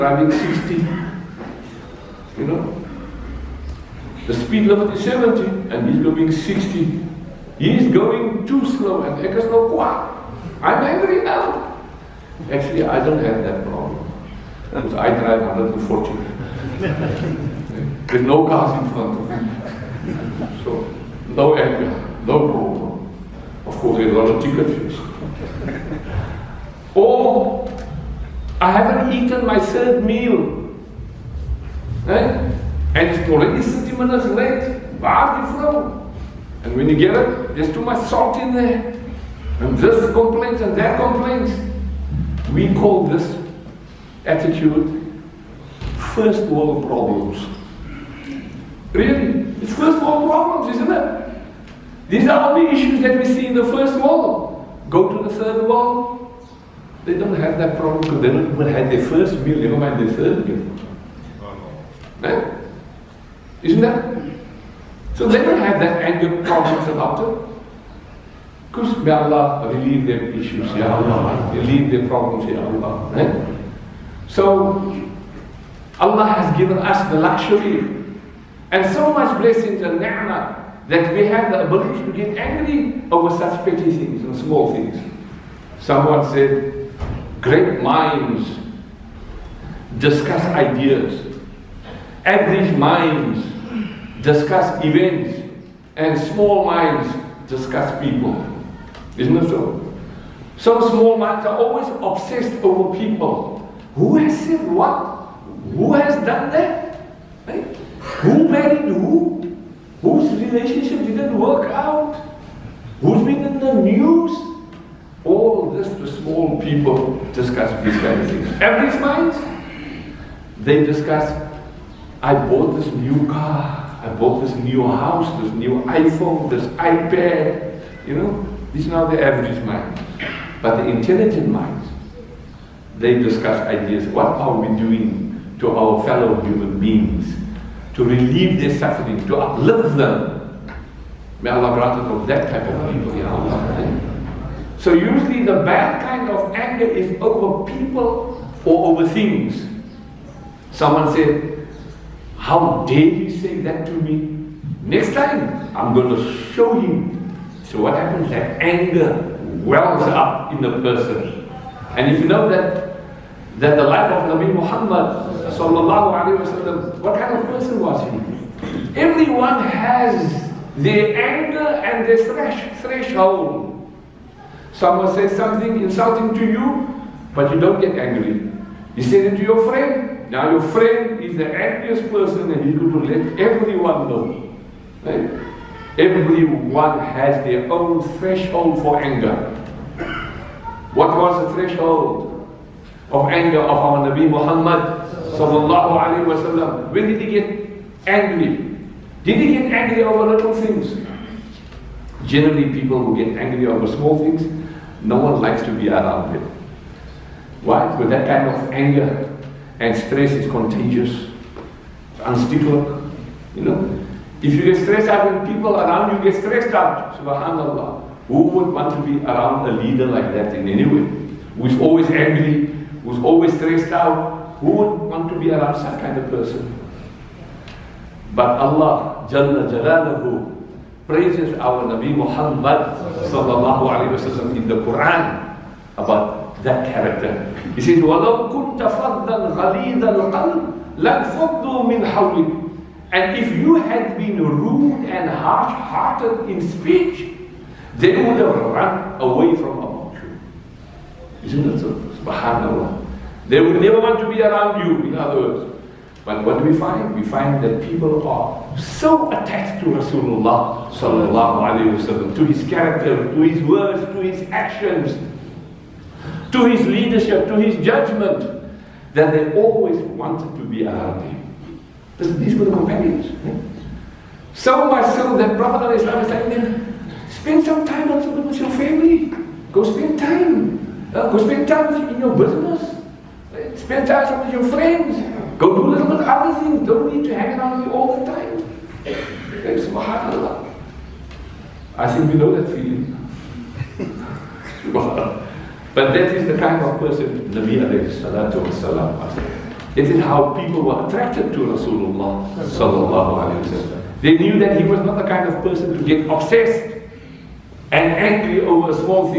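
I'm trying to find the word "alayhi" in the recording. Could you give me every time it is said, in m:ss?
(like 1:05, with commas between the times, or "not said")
3:53, 4:21, 4:57, 5:03.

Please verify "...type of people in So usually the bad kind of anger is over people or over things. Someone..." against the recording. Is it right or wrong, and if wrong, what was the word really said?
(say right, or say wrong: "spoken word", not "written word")
right.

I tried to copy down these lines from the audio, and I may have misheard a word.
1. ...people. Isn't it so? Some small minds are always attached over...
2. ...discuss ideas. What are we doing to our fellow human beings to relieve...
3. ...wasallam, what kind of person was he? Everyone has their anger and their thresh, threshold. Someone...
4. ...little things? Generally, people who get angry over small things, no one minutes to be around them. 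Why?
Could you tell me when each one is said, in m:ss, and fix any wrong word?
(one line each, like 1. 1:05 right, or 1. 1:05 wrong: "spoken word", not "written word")
1. 1:38 wrong: "obsessed", not "attached"
2. 2:13 right
3. 2:45 right
4. 3:20 wrong: "likes", not "minutes".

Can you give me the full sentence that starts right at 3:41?
Who's always angry, who's always stressed out, who would want to be around such kind of person?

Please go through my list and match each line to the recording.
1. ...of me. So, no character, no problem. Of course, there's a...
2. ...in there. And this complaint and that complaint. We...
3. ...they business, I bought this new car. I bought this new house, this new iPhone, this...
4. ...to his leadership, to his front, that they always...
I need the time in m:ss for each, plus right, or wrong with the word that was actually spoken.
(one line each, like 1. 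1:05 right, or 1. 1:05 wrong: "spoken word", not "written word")
1. 0:19 wrong: "anger", not "character"
2. 0:38 right
3. 2:00 wrong: "discuss", not "business"
4. 4:26 wrong: "judgment", not "front".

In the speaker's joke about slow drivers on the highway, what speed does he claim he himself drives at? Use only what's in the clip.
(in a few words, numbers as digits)
140.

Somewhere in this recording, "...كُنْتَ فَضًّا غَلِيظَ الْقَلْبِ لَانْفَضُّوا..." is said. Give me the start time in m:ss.
3:58.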